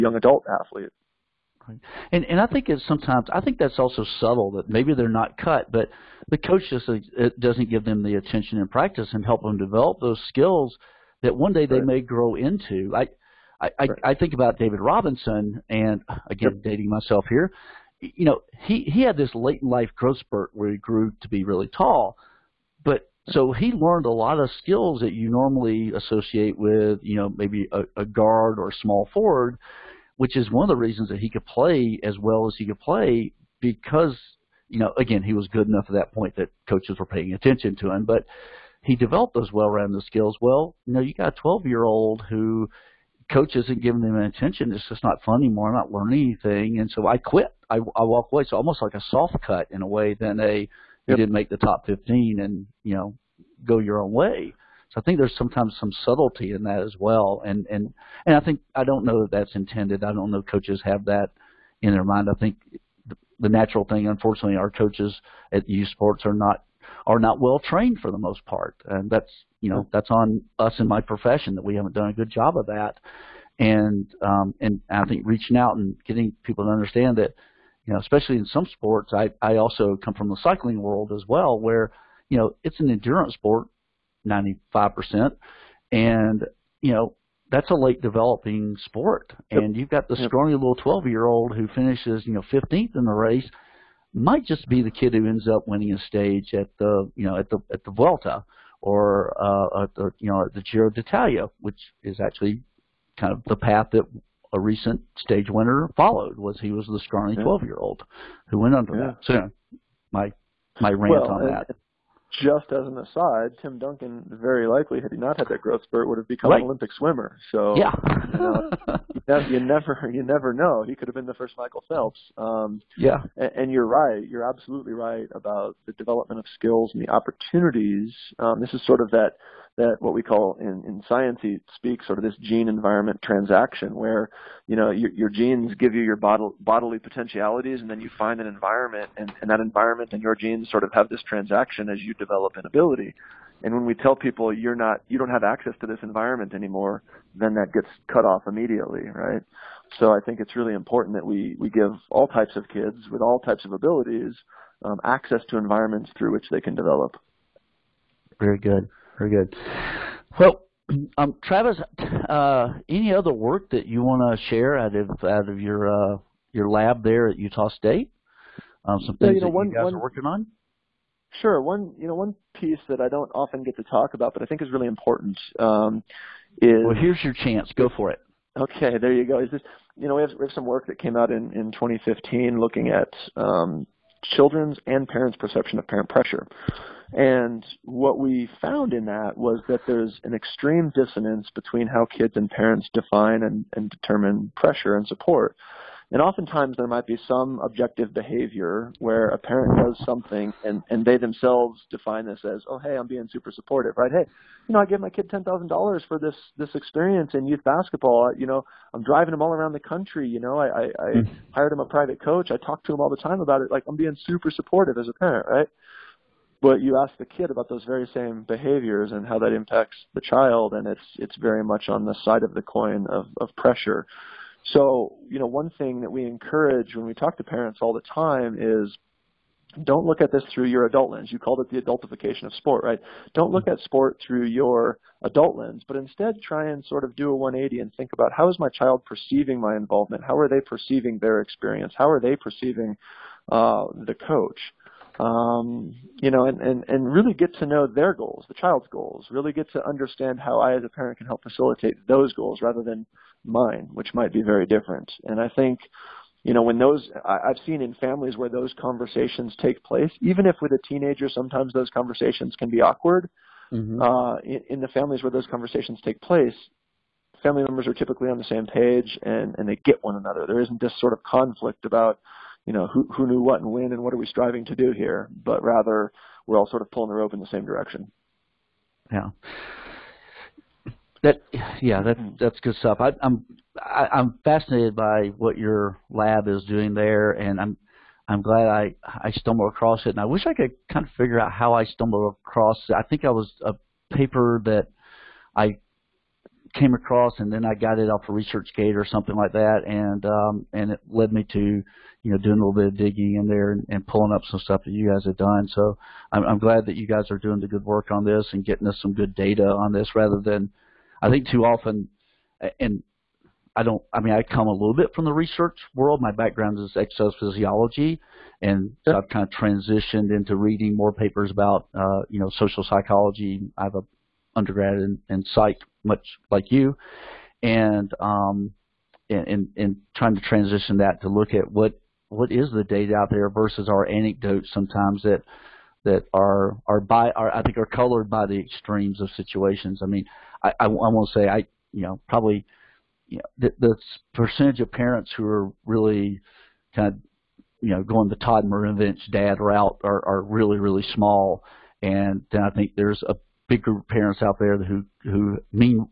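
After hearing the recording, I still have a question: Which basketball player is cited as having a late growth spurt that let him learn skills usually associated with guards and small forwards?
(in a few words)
David Robinson.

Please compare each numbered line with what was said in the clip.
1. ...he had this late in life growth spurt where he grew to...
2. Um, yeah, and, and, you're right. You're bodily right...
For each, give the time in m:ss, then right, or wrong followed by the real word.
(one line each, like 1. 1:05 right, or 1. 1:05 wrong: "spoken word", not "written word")
1. 0:18 right
2. 2:02 wrong: "absolutely", not "bodily".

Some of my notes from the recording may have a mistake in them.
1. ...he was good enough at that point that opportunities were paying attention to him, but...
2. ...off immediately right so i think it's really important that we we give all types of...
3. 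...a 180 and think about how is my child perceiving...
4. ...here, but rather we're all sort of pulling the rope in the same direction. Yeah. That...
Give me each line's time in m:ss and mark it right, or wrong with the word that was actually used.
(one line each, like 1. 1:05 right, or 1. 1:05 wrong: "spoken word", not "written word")
1. 0:35 wrong: "coaches", not "opportunities"
2. 2:28 right
3. 3:57 right
4. 4:34 right.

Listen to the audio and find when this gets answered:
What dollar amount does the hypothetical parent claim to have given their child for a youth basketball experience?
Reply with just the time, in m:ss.
3:25.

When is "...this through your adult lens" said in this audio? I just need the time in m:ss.
3:50.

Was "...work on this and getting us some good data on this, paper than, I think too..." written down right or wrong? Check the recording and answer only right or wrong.
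wrong.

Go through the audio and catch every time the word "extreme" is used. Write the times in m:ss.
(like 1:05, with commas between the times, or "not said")
3:10, 5:38.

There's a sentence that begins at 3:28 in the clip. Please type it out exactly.
You know, I'm driving him all around the country.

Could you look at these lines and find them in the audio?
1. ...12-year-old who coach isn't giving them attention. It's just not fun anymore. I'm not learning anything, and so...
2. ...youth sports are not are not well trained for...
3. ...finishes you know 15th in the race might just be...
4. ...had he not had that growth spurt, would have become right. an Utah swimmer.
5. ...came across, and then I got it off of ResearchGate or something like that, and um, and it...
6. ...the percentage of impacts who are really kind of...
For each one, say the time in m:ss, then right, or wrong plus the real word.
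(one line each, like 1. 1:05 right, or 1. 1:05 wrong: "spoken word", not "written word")
1. 0:41 right
2. 1:05 right
3. 1:31 right
4. 1:55 wrong: "Olympic", not "Utah"
5. 4:56 right
6. 5:43 wrong: "parents", not "impacts".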